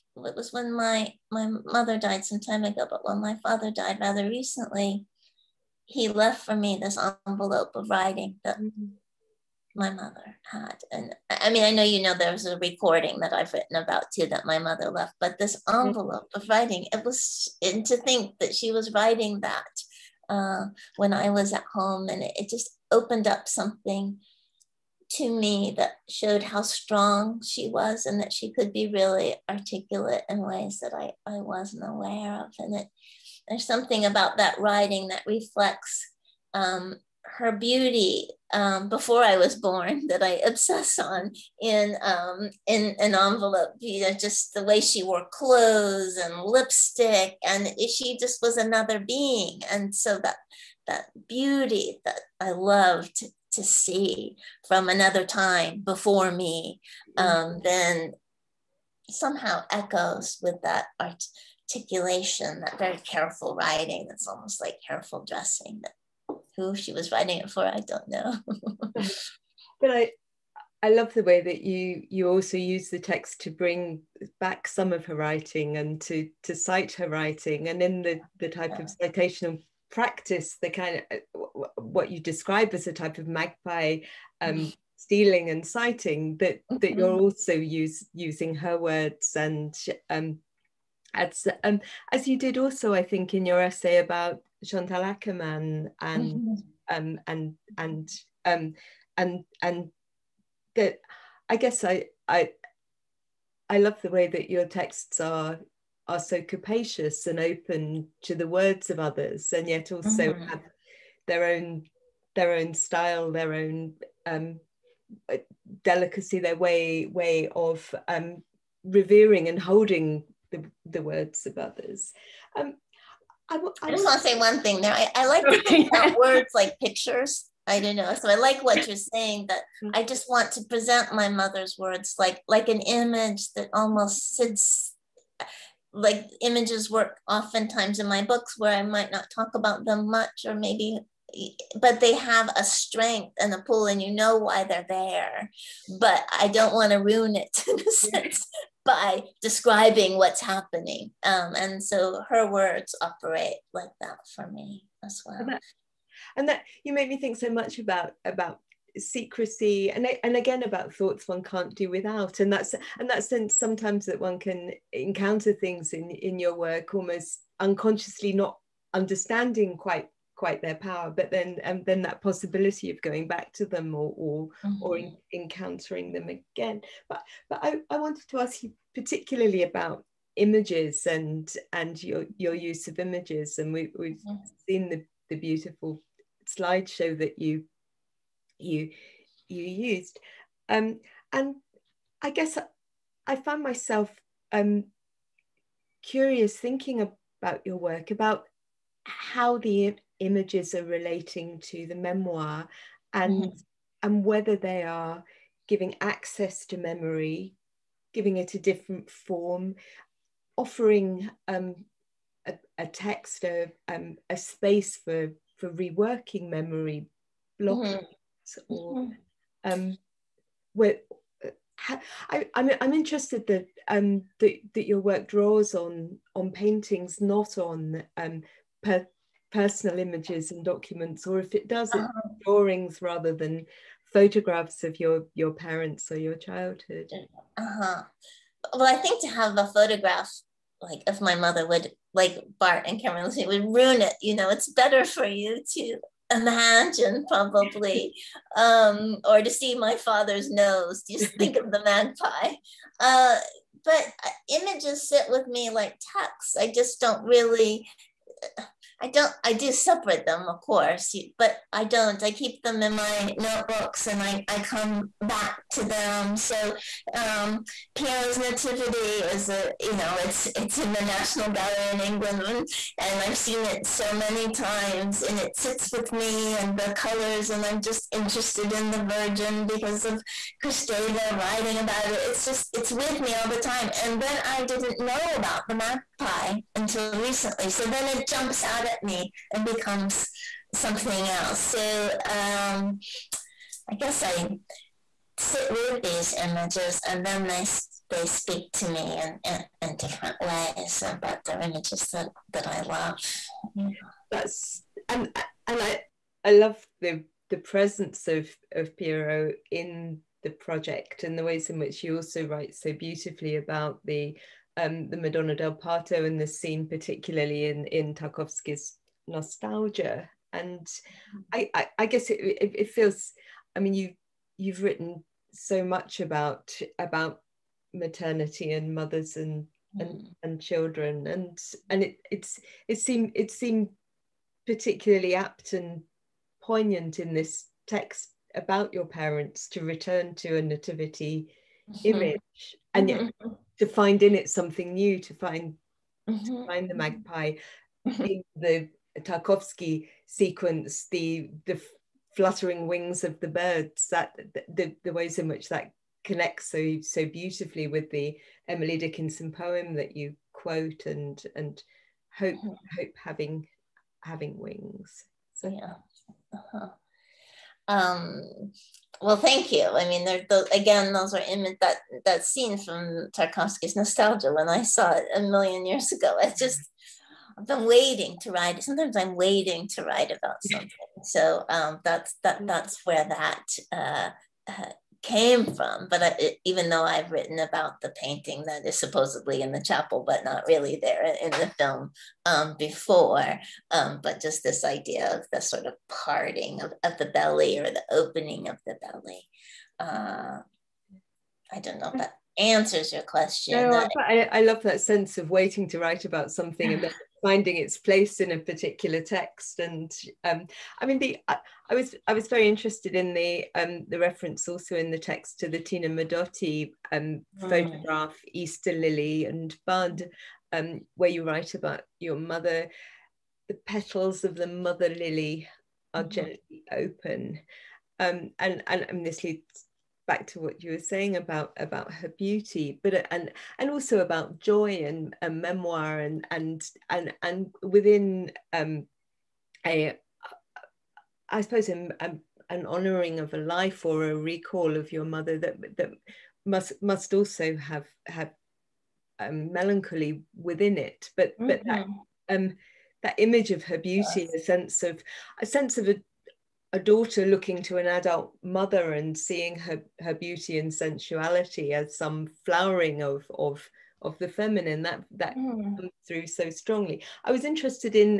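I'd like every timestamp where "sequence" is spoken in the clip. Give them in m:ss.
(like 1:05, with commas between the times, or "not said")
5:50.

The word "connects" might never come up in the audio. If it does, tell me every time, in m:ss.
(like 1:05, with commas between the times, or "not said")
5:56.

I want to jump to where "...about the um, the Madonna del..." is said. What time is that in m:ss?
5:13.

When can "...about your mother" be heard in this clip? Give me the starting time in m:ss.
7:01.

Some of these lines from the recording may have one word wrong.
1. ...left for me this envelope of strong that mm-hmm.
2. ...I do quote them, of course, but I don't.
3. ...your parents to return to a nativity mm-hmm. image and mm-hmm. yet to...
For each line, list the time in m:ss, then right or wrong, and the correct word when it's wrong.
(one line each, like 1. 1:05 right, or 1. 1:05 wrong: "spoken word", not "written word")
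1. 0:06 wrong: "writing", not "strong"
2. 4:19 wrong: "separate", not "quote"
3. 5:38 right.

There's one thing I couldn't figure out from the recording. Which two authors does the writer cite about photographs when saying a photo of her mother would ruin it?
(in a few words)
Barthes and Cameron.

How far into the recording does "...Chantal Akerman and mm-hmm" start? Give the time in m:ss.
1:34.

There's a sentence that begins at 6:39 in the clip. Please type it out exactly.
Uh, I don't know if that answers your question.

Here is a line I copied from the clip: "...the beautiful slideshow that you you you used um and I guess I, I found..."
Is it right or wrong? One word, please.
right.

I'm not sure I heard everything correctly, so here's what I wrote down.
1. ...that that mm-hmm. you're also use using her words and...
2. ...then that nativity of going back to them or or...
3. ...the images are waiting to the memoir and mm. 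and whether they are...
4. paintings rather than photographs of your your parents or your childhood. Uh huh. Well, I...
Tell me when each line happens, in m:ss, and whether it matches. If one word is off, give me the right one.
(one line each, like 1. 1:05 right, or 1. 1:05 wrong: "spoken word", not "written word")
1. 1:26 right
2. 2:51 wrong: "possibility", not "nativity"
3. 3:19 wrong: "relating", not "waiting"
4. 3:52 wrong: "drawings", not "paintings".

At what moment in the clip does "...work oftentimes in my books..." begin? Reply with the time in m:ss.
2:16.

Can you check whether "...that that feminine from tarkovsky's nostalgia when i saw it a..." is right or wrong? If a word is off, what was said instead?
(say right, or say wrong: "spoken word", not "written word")
wrong: "scene", not "feminine".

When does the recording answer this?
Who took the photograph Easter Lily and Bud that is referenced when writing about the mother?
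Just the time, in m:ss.
6:55.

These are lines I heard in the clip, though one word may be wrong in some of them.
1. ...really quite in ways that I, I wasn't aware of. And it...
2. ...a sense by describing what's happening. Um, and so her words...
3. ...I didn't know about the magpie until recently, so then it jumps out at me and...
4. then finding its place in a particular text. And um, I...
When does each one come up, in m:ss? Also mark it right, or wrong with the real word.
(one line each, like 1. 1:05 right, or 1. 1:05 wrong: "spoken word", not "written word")
1. 0:28 wrong: "articulate", not "quite"
2. 2:27 right
3. 4:44 right
4. 6:47 right.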